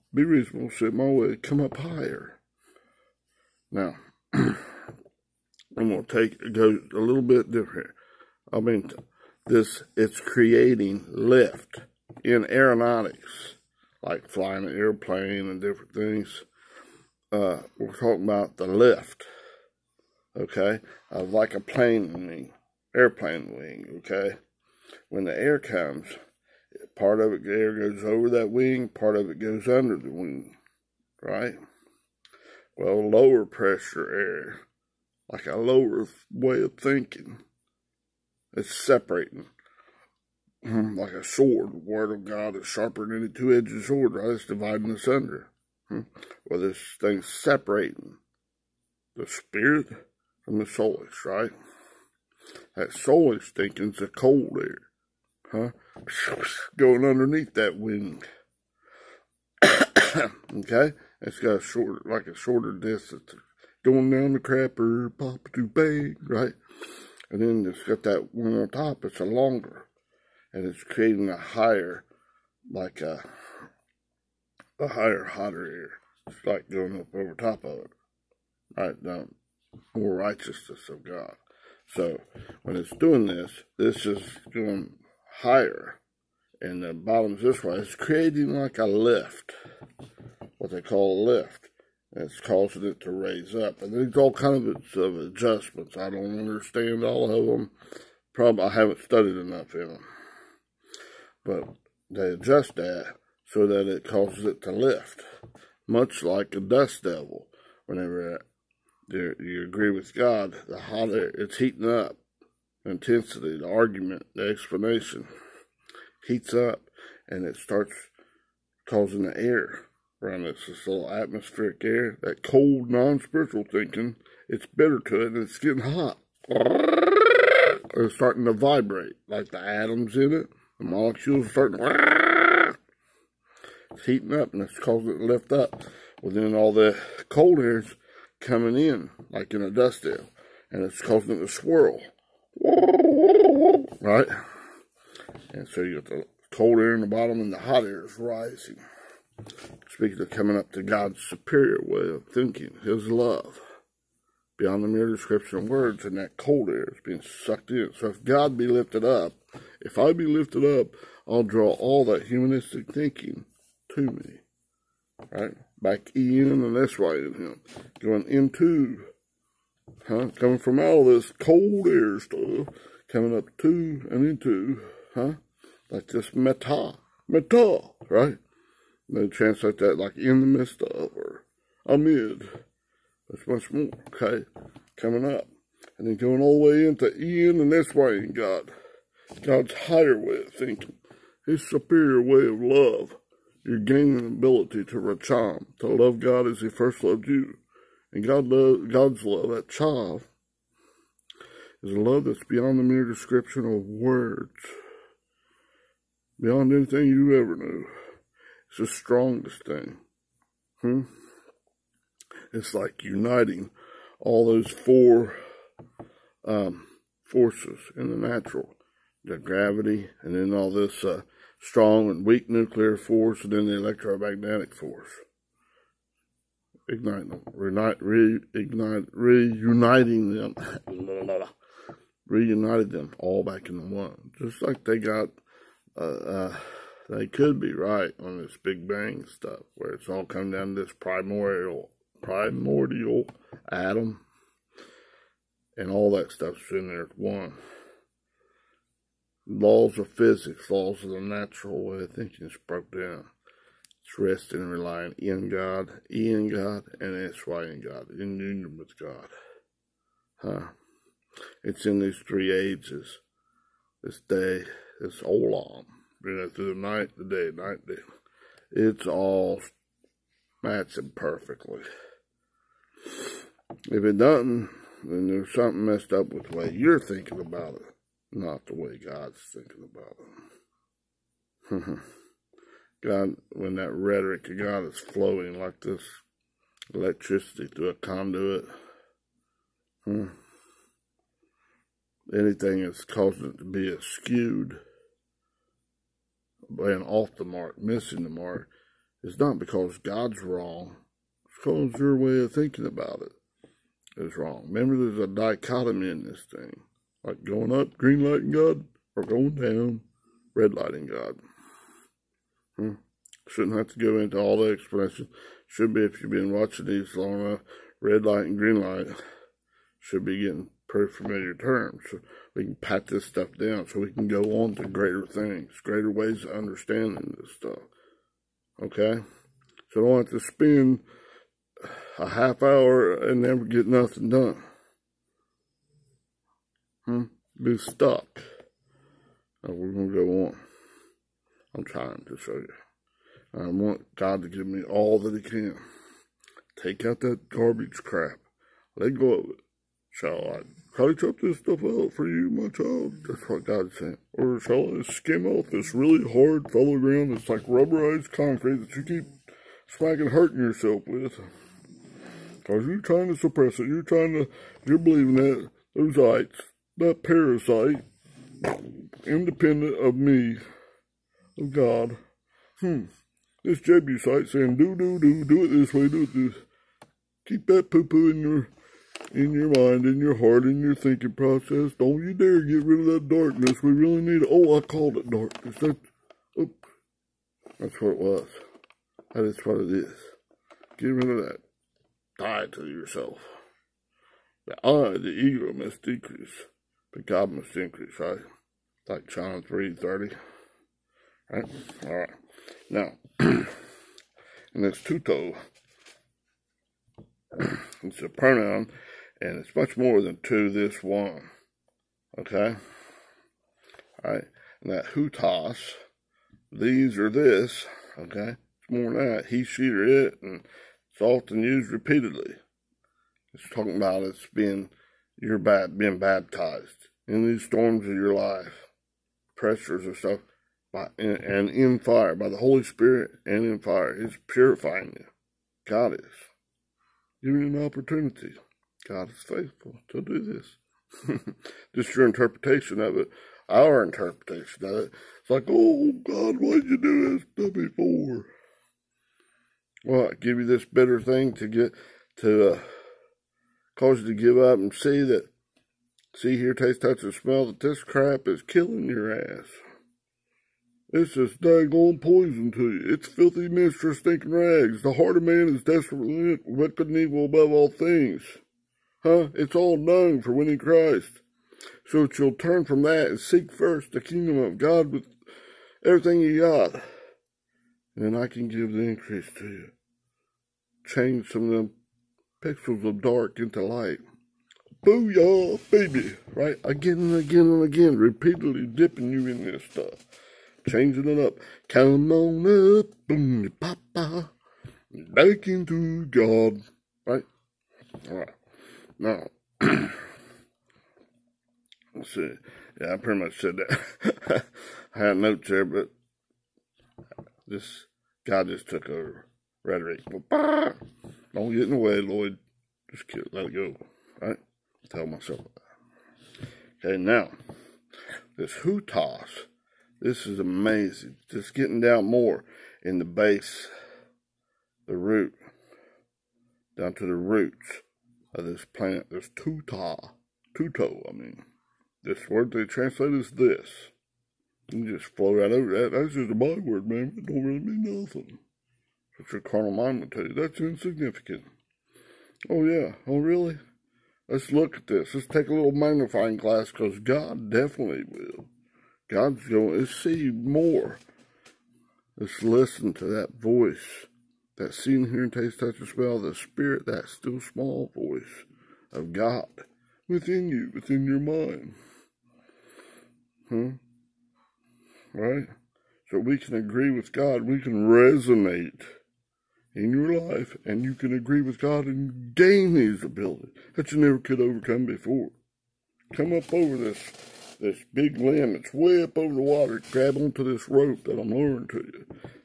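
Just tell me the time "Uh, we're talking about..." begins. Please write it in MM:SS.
00:17.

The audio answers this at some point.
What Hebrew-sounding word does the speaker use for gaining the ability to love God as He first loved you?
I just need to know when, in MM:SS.
03:14.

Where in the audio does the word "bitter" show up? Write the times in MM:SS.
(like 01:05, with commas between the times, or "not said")
02:04, 07:30.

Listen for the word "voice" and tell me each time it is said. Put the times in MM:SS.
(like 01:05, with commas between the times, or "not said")
09:13, 09:18.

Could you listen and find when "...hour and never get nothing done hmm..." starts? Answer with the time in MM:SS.
05:32.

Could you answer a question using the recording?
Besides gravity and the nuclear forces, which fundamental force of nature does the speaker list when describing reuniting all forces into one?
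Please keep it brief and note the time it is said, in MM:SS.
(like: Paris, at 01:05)
electromagnetic force, at 03:43.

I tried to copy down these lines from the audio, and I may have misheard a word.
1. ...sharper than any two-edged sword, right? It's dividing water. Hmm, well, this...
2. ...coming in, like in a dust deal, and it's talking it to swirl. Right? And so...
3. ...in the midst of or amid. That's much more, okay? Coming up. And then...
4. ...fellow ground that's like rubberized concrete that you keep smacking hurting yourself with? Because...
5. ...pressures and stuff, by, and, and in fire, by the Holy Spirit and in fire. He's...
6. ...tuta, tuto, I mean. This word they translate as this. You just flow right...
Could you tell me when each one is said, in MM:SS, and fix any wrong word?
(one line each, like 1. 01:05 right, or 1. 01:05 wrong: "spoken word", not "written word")
1. 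00:42 wrong: "asunder", not "water"
2. 02:18 wrong: "causing", not "talking"
3. 03:00 right
4. 05:56 right
5. 07:09 right
6. 08:49 right.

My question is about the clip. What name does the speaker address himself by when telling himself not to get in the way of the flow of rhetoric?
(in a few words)
Lloyd.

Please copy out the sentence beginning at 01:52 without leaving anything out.
Intensity, the argument, the explanation heats up and it starts causing the air around us.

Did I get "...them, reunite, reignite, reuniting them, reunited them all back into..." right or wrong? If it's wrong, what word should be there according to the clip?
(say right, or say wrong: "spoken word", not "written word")
right.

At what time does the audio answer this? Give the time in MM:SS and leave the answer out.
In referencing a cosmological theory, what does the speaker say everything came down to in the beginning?
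04:00.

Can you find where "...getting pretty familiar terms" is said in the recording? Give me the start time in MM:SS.
05:20.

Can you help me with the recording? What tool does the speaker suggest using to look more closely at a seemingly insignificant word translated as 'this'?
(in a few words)
magnifying glass.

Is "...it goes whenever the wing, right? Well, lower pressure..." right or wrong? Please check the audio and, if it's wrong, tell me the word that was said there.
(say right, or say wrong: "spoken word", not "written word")
wrong: "under", not "whenever".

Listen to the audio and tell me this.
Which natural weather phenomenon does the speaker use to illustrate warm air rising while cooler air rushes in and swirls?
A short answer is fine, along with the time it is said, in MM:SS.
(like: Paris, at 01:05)
dust devil, at 01:46.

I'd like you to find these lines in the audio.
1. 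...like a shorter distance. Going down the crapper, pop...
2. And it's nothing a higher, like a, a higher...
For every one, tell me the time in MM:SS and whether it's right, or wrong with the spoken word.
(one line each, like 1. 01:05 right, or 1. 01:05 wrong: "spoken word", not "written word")
1. 01:02 right
2. 01:10 wrong: "creating", not "nothing".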